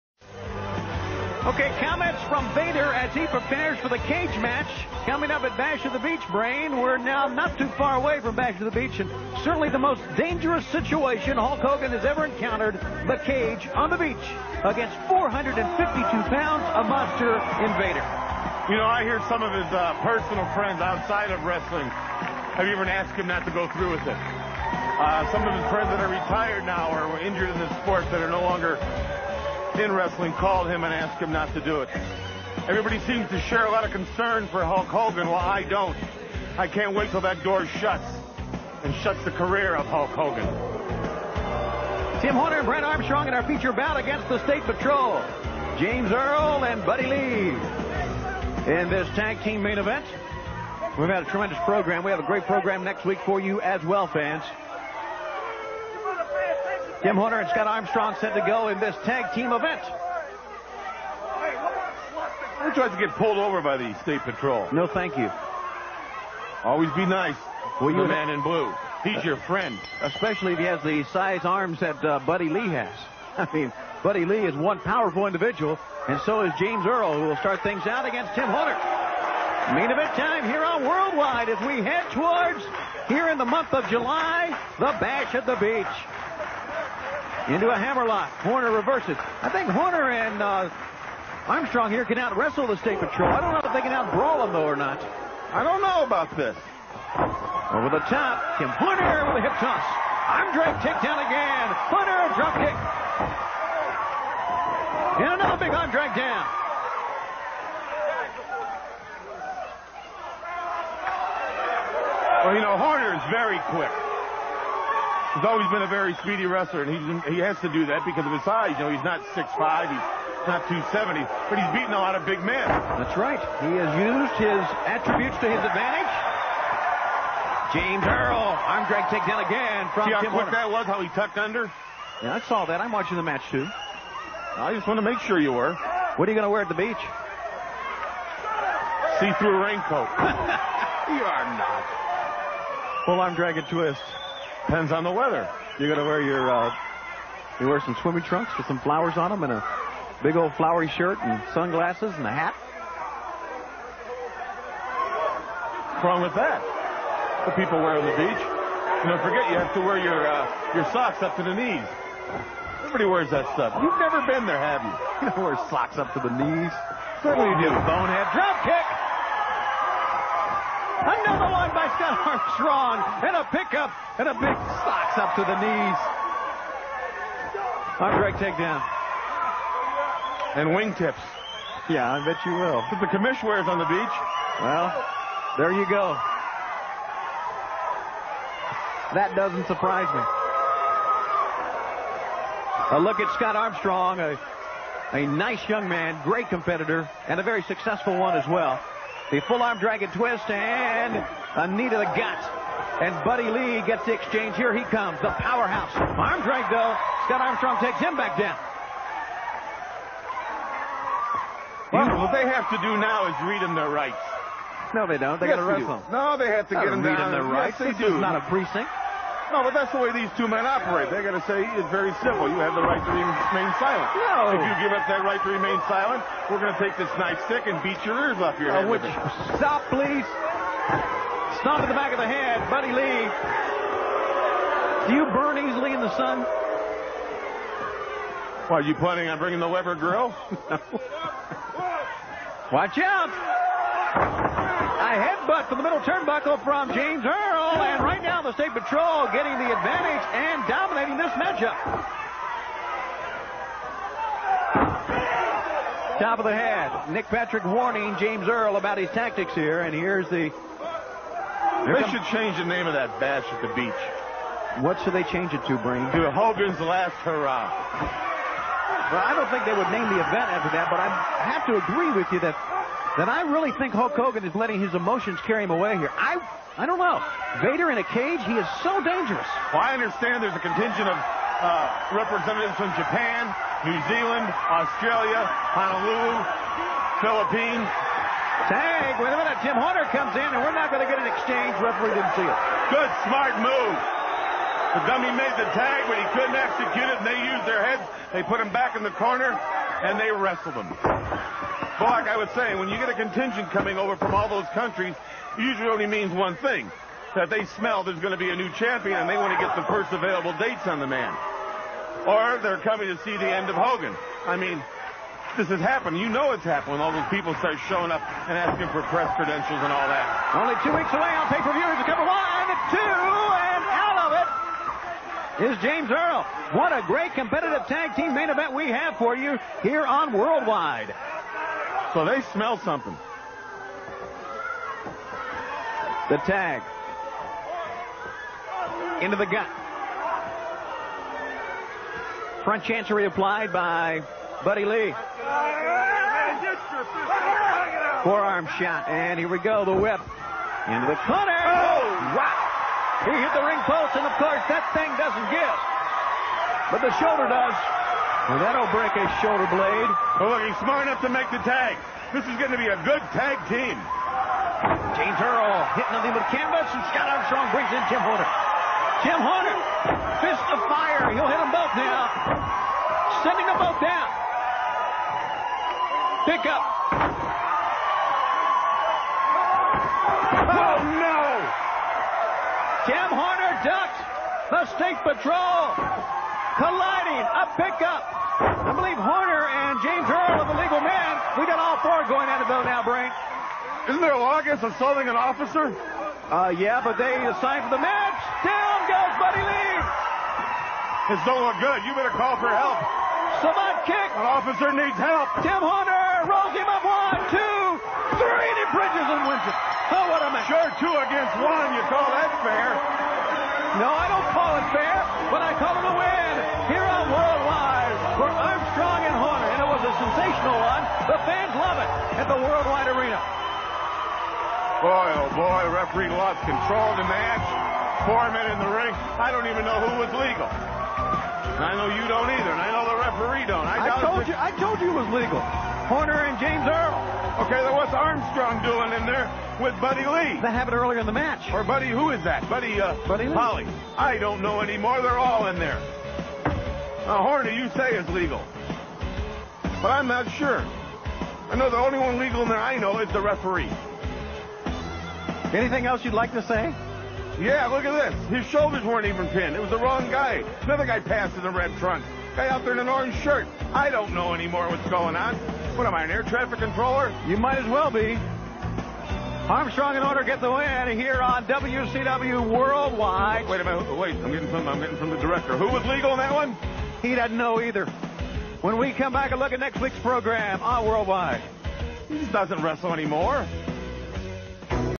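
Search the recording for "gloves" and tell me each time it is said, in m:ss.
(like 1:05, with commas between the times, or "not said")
not said.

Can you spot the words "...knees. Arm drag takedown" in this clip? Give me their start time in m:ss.
2:55.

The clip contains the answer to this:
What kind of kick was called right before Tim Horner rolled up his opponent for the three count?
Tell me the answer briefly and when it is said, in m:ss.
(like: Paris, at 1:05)
Savate kick, at 6:43.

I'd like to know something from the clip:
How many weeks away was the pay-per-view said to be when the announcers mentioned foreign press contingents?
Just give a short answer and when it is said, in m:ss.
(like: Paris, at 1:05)
2, at 5:20.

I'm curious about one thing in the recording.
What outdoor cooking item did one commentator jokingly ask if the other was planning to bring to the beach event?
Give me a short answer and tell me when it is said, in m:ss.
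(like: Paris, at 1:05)
Weber grill, at 3:59.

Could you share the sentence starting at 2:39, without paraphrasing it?
You don't forget, you have to wear your, uh, your socks up to the knees.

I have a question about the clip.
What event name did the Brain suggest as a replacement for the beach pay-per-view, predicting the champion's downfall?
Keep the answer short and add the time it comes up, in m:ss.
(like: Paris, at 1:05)
Hogan's Last Hurrah, at 4:26.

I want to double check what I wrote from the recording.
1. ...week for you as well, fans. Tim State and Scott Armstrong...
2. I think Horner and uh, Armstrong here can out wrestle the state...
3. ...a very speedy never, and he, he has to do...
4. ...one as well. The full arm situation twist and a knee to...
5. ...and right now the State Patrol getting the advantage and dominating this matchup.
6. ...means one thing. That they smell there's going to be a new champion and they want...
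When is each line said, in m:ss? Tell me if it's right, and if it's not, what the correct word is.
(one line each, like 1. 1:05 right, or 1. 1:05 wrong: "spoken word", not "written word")
1. 0:53 wrong: "Horner", not "State"
2. 1:29 right
3. 1:55 wrong: "wrestler", not "never"
4. 3:18 wrong: "dragon", not "situation"
5. 4:07 right
6. 5:06 right.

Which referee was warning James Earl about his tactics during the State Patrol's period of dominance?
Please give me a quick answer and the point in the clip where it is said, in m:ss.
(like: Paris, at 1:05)
Nick Patrick, at 4:17.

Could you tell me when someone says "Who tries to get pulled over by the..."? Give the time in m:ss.
1:02.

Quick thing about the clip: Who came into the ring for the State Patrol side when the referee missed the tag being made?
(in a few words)
Jim Hunter.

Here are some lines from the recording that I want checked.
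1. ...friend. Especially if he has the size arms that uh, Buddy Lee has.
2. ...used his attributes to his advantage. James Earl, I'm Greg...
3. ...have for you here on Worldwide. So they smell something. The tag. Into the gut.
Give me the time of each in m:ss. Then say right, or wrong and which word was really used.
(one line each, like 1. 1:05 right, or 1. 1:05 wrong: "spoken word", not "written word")
1. 1:09 right
2. 2:03 right
3. 5:28 right.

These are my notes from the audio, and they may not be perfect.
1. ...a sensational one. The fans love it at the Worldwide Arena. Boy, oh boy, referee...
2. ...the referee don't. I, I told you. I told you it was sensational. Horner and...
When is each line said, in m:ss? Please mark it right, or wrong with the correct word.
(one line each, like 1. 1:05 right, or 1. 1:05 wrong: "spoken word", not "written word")
1. 7:00 right
2. 7:13 wrong: "legal", not "sensational".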